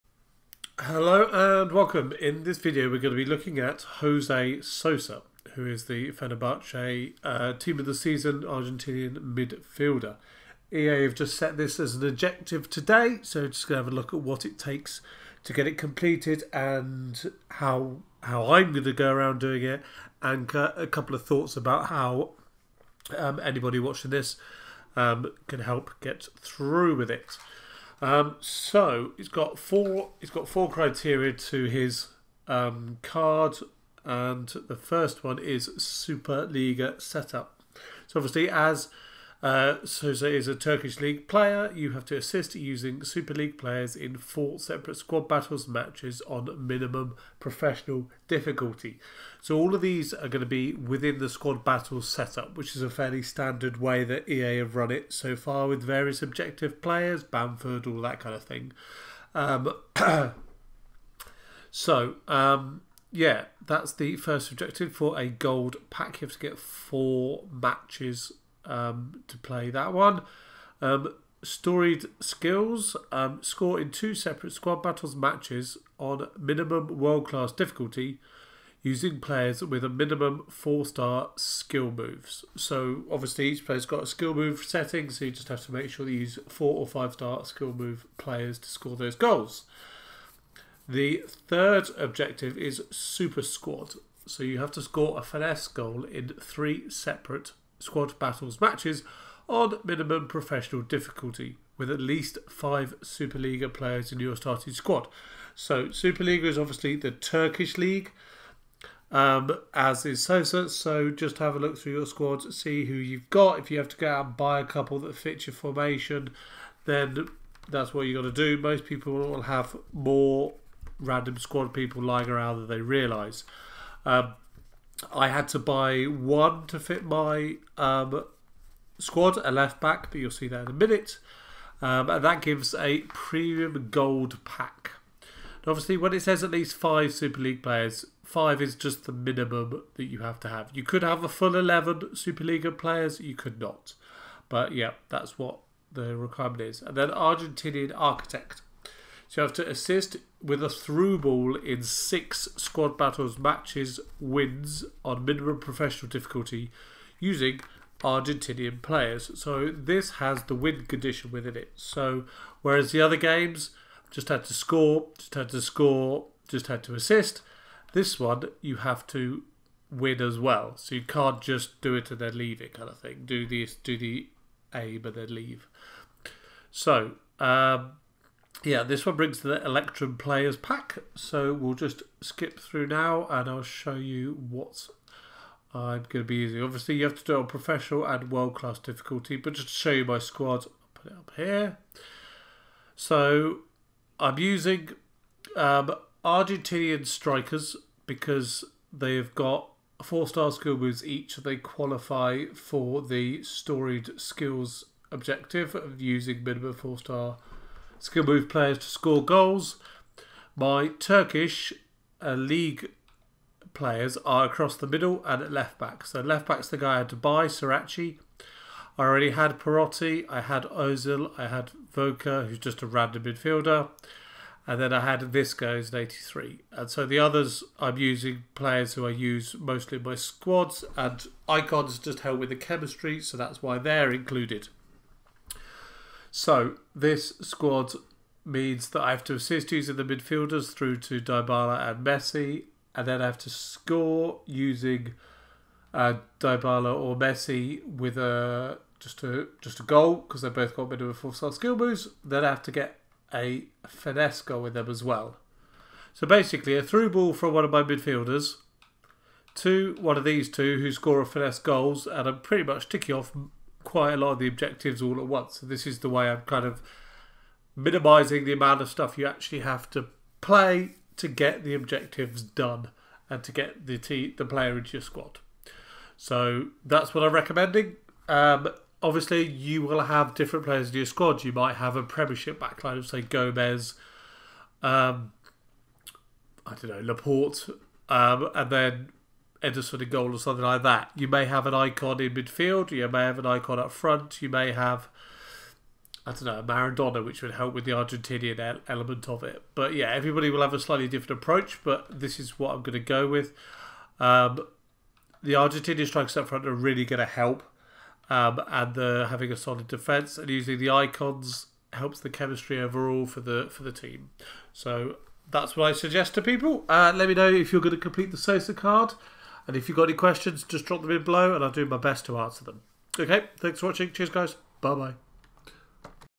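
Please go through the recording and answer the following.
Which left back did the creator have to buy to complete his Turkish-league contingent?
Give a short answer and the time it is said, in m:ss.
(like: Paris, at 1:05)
Sirachi, at 3:37.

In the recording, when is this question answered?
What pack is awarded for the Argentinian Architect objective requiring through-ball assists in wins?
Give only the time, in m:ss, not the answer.
2:59.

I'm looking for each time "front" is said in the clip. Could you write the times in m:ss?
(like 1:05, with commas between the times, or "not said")
4:53, 5:06.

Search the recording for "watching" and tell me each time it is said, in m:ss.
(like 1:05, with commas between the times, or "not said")
0:23, 5:23.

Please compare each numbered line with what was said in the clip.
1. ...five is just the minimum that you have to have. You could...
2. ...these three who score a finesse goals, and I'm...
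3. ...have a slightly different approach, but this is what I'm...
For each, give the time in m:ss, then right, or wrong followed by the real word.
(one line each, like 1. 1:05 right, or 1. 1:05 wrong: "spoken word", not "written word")
1. 2:18 right
2. 4:20 wrong: "two", not "three"
3. 5:00 right.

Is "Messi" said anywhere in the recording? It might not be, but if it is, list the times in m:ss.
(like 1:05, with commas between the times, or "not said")
4:02, 4:07.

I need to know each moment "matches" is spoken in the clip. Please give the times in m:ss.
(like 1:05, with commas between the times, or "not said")
0:45, 1:07, 1:15, 1:38, 2:33.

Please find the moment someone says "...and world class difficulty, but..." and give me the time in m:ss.
3:08.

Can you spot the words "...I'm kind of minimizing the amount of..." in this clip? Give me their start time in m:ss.
4:26.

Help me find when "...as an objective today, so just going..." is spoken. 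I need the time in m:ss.
0:11.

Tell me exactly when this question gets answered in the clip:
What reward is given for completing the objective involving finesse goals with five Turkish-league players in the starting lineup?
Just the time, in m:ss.
2:13.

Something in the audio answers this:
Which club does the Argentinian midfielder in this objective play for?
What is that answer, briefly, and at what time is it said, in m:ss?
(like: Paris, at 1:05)
Fenerbahce, at 0:06.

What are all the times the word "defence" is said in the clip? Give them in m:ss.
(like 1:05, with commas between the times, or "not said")
5:09.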